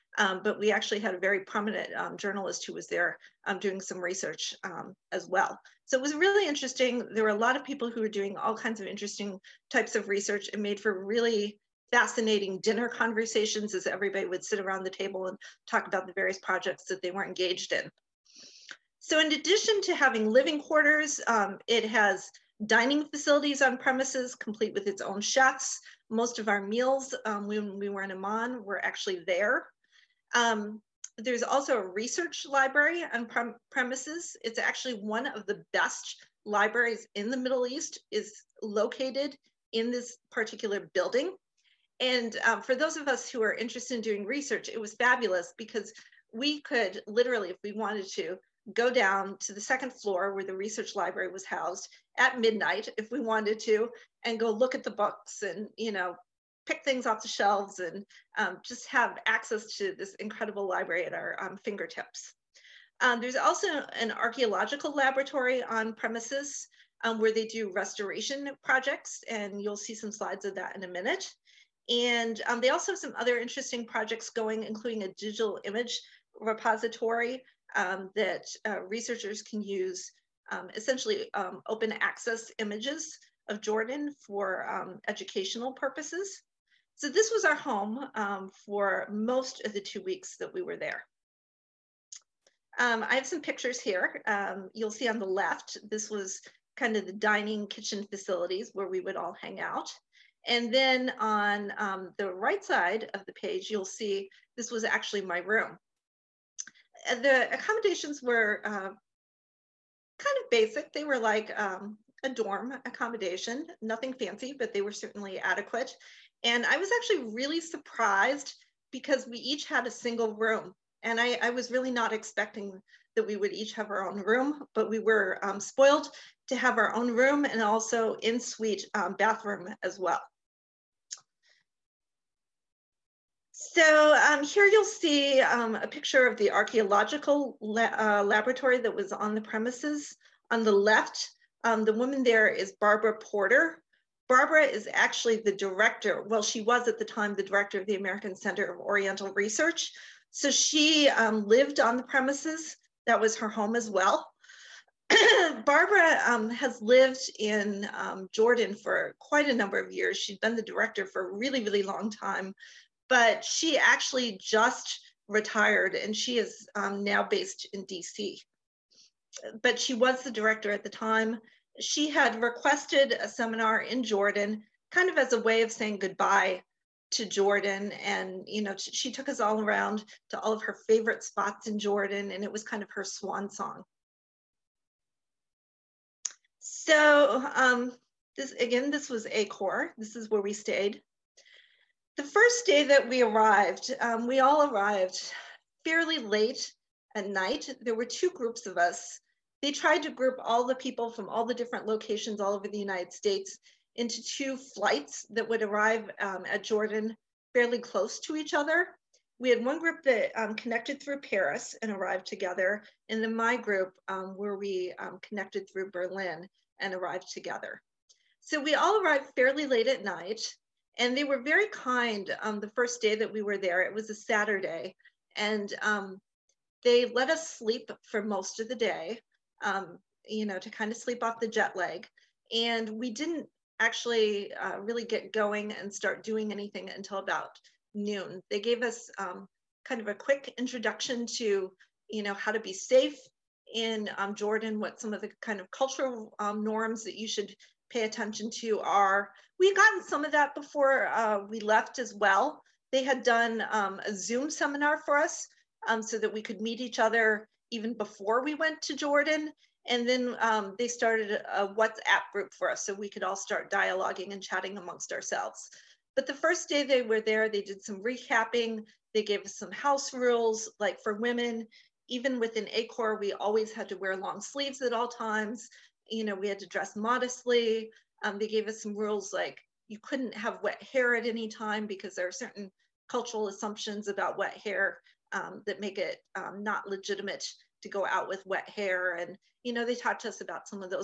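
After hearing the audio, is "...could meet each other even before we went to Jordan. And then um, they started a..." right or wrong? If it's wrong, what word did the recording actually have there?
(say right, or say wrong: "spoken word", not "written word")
right.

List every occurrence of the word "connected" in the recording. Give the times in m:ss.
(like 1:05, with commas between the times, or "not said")
3:30, 3:35.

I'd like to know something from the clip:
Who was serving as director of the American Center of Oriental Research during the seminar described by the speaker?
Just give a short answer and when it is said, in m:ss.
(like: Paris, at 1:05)
Barbara Porter, at 2:22.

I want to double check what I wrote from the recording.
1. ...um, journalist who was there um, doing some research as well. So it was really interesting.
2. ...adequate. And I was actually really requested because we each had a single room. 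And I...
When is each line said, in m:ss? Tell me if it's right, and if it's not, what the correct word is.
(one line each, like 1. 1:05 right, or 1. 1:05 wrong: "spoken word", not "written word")
1. 0:01 right
2. 1:55 wrong: "surprised", not "requested".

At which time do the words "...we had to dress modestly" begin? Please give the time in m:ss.
4:36.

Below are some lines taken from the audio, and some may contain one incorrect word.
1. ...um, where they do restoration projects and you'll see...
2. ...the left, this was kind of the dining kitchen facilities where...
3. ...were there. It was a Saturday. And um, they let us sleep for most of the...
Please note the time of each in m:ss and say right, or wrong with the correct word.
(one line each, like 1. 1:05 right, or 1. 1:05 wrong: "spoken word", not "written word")
1. 1:07 right
2. 1:35 right
3. 3:43 right.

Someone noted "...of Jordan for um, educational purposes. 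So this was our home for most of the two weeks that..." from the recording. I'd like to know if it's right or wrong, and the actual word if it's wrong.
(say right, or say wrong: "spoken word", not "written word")
right.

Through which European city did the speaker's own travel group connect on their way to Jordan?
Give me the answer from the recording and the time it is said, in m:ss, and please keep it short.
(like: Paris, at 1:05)
Berlin, at 3:35.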